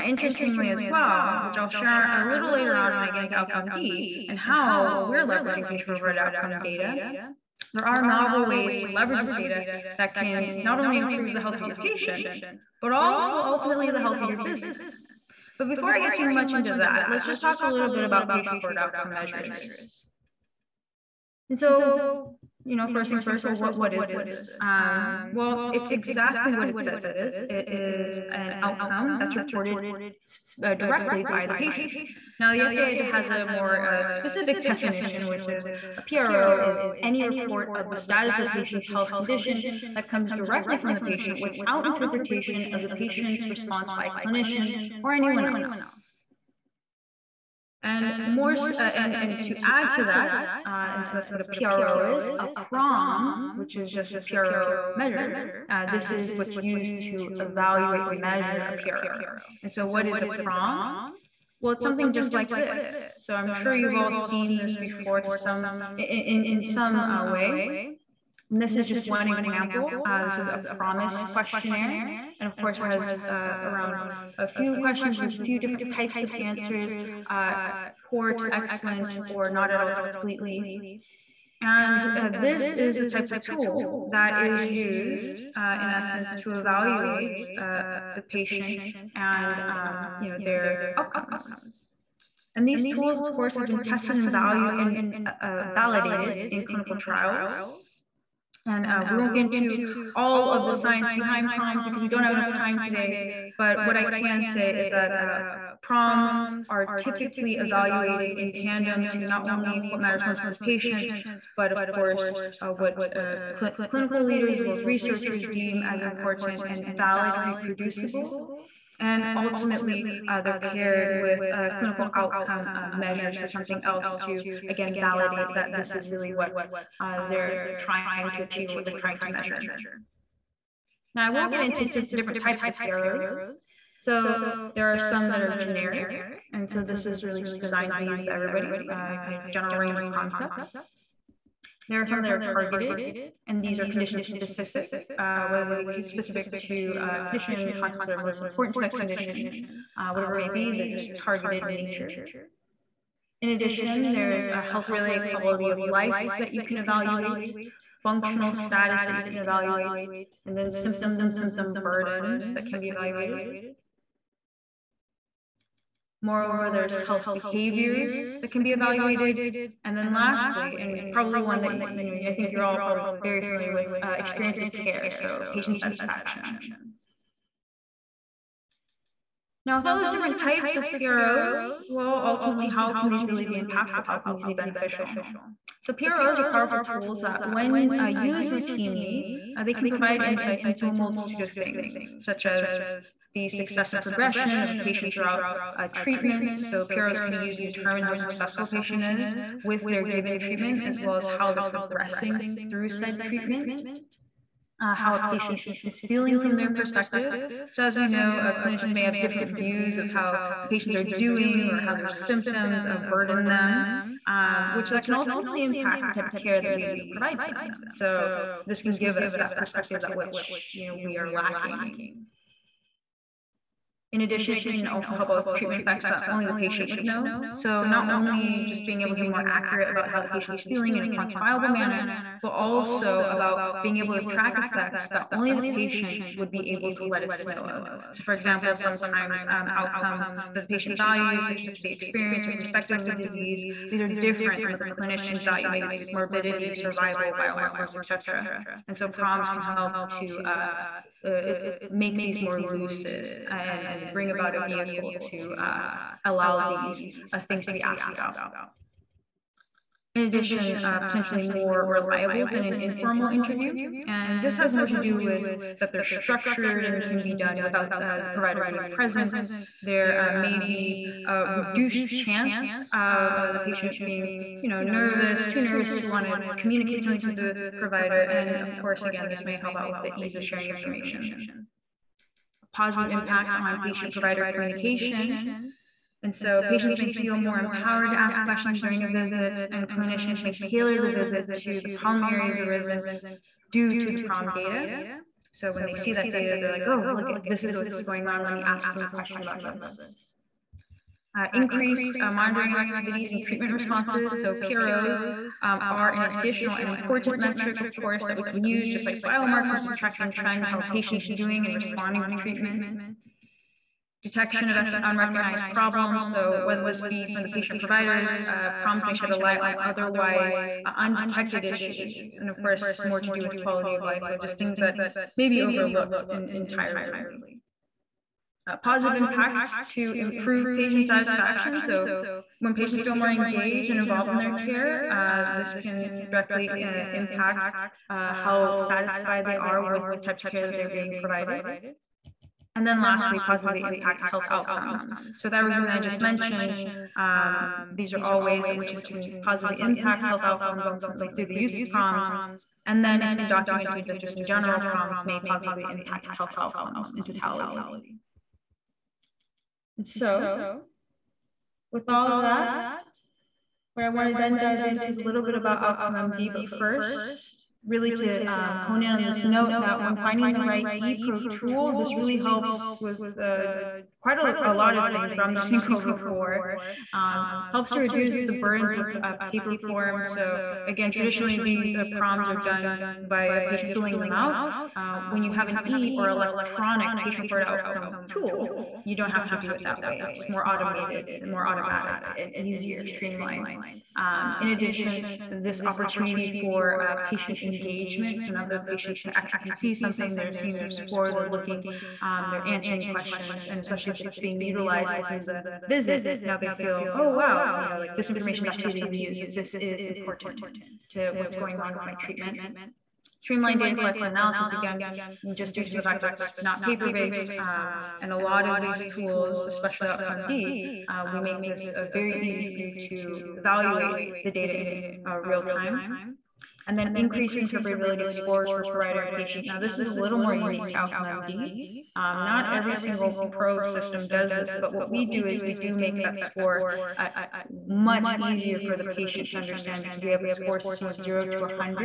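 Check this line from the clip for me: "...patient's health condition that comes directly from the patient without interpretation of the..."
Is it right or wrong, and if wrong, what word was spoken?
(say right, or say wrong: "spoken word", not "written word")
right.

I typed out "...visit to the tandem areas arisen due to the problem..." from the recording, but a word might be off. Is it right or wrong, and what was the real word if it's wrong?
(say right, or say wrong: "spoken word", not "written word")
wrong: "problem", not "tandem".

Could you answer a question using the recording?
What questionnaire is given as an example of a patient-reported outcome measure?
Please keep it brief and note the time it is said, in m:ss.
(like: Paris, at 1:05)
PROMIS, at 1:10.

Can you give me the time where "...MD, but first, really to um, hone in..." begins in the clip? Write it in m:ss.
6:06.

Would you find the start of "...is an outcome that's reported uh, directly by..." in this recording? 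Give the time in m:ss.
0:27.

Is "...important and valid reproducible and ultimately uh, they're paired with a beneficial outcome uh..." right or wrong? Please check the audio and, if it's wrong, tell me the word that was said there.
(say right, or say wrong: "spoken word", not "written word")
wrong: "clinical", not "beneficial".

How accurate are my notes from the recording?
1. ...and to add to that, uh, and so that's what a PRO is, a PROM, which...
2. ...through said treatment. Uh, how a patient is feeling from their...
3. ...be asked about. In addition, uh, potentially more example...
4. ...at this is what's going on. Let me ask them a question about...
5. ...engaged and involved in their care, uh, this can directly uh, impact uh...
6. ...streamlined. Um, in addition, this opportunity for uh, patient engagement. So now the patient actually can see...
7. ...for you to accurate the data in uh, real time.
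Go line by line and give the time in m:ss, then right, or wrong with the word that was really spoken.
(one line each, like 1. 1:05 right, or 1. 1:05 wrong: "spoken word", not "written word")
1. 0:49 right
2. 3:22 right
3. 4:17 wrong: "reliable", not "example"
4. 4:57 right
5. 5:33 right
6. 6:33 right
7. 7:02 wrong: "evaluate", not "accurate".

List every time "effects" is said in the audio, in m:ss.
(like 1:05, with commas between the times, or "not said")
3:45, 3:54.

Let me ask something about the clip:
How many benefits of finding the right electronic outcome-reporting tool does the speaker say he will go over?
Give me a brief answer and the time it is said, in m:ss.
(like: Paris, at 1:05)
4, at 6:16.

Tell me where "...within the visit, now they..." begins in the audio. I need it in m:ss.
6:45.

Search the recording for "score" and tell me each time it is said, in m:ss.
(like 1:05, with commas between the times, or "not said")
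6:40, 7:08, 7:16, 7:20.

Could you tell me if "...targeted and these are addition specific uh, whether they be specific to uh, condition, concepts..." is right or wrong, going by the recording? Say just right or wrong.
wrong.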